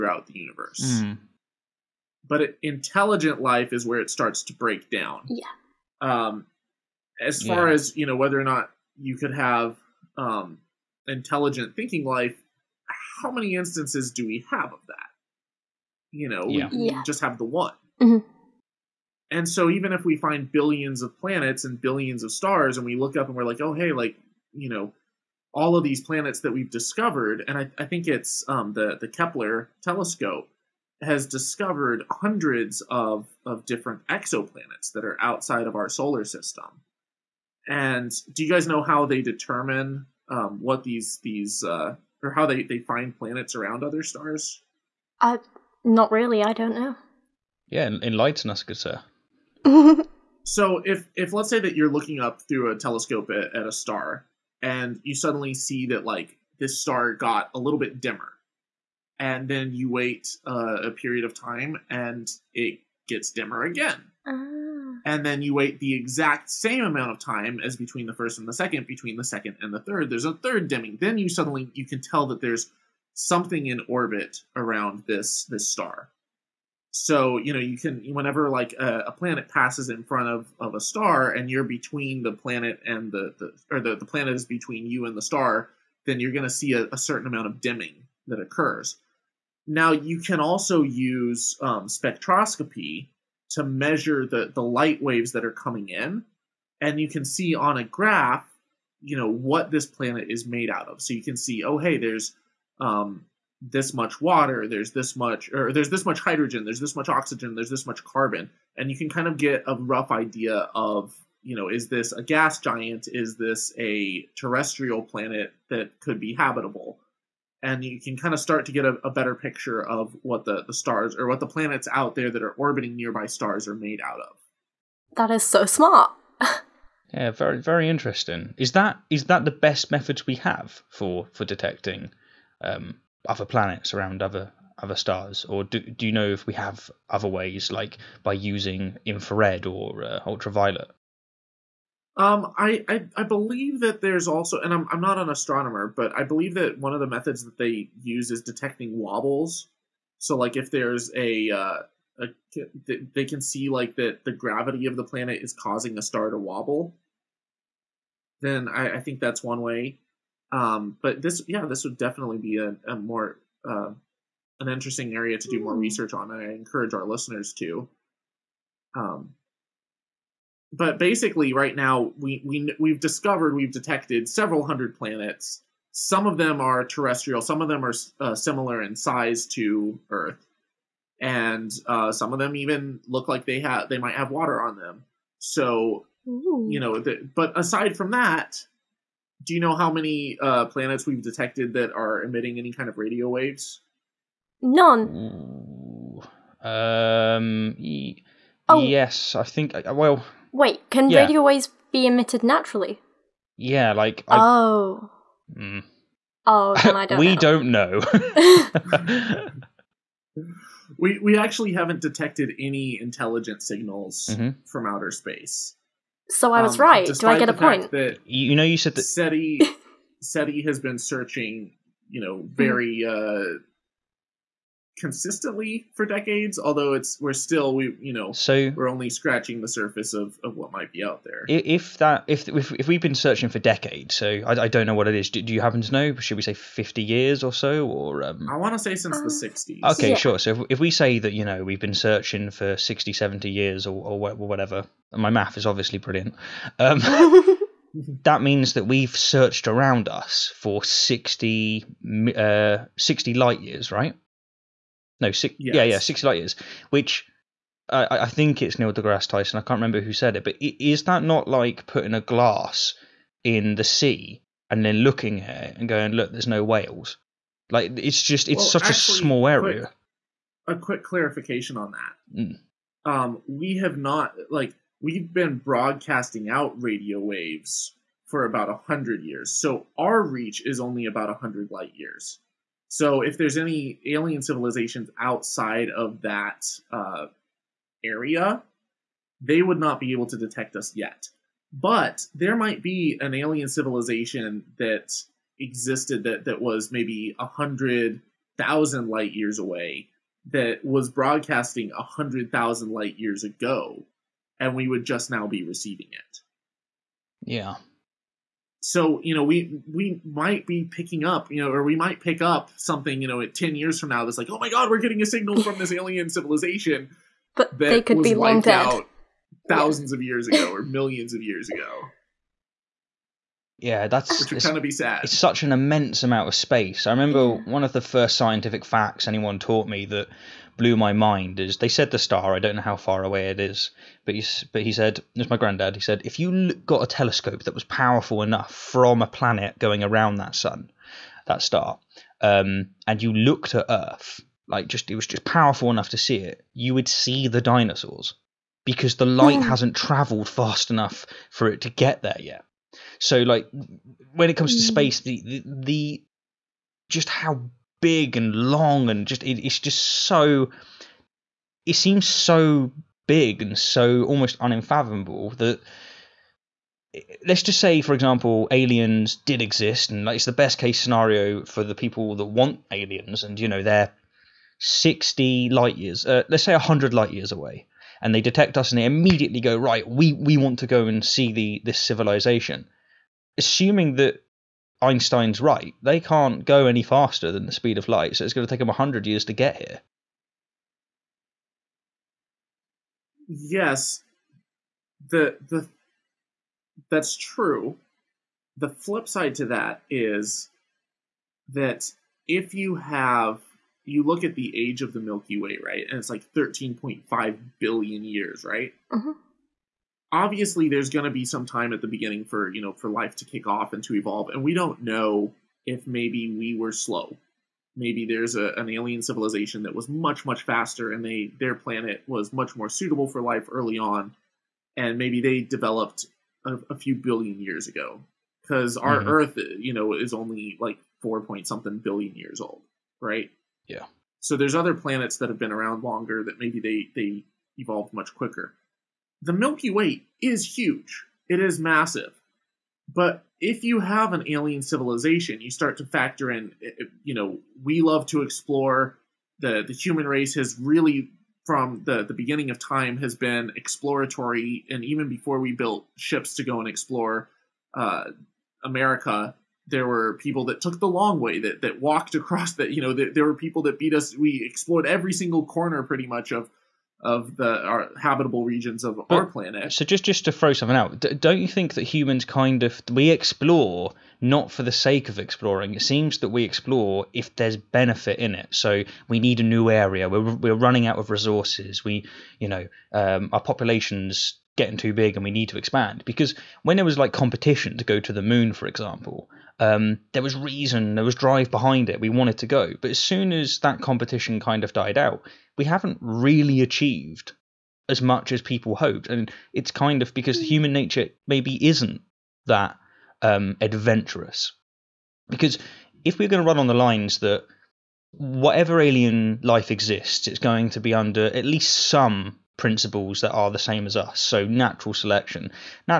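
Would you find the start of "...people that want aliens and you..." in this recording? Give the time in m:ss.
6:11.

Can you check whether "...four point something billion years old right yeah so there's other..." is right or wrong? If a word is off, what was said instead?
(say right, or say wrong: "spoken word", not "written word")
right.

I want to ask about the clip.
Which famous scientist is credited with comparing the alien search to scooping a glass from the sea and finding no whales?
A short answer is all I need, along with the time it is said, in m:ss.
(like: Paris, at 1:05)
Neil deGrasse Tyson, at 4:18.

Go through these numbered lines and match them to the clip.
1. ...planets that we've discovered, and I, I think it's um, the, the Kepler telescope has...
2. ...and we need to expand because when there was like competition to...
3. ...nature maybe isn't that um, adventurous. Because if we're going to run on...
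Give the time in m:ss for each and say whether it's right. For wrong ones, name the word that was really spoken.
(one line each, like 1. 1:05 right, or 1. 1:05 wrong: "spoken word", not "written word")
1. 0:26 right
2. 8:05 right
3. 8:20 right.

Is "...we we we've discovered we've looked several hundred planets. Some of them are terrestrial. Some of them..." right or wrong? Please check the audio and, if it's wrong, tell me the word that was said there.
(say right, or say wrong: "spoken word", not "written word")
wrong: "detected", not "looked".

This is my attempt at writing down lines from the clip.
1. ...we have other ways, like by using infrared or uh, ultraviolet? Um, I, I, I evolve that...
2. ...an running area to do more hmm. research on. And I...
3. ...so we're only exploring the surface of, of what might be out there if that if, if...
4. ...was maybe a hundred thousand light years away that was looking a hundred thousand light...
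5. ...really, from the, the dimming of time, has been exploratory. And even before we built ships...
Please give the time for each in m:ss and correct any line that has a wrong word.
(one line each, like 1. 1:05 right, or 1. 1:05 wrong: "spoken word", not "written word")
1. 2:16 wrong: "believe", not "evolve"
2. 2:44 wrong: "interesting", not "running"
3. 3:48 wrong: "scratching", not "exploring"
4. 4:56 wrong: "broadcasting", not "looking"
5. 7:30 wrong: "beginning", not "dimming".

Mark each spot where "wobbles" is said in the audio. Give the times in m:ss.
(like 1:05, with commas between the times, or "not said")
2:28, 2:36.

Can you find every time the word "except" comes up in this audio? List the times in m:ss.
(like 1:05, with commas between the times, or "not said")
not said.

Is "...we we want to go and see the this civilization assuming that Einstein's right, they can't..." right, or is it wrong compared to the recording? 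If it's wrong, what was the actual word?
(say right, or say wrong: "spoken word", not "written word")
right.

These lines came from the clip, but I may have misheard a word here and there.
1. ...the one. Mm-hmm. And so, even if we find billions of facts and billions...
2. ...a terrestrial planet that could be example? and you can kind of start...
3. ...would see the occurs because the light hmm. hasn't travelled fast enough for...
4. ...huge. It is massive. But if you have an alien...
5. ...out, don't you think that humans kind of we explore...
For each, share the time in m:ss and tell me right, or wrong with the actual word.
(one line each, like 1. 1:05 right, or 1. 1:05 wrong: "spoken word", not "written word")
1. 0:17 wrong: "planets", not "facts"
2. 1:53 wrong: "habitable", not "example"
3. 5:46 wrong: "dinosaurs", not "occurs"
4. 7:20 right
5. 7:50 right.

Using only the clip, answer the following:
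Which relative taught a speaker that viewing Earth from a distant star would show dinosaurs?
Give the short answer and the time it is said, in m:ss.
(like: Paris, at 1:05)
granddad, at 5:35.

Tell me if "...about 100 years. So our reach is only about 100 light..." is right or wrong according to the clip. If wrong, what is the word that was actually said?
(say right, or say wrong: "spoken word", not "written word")
right.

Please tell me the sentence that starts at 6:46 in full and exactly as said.
And it's like 13.5 billion years, right?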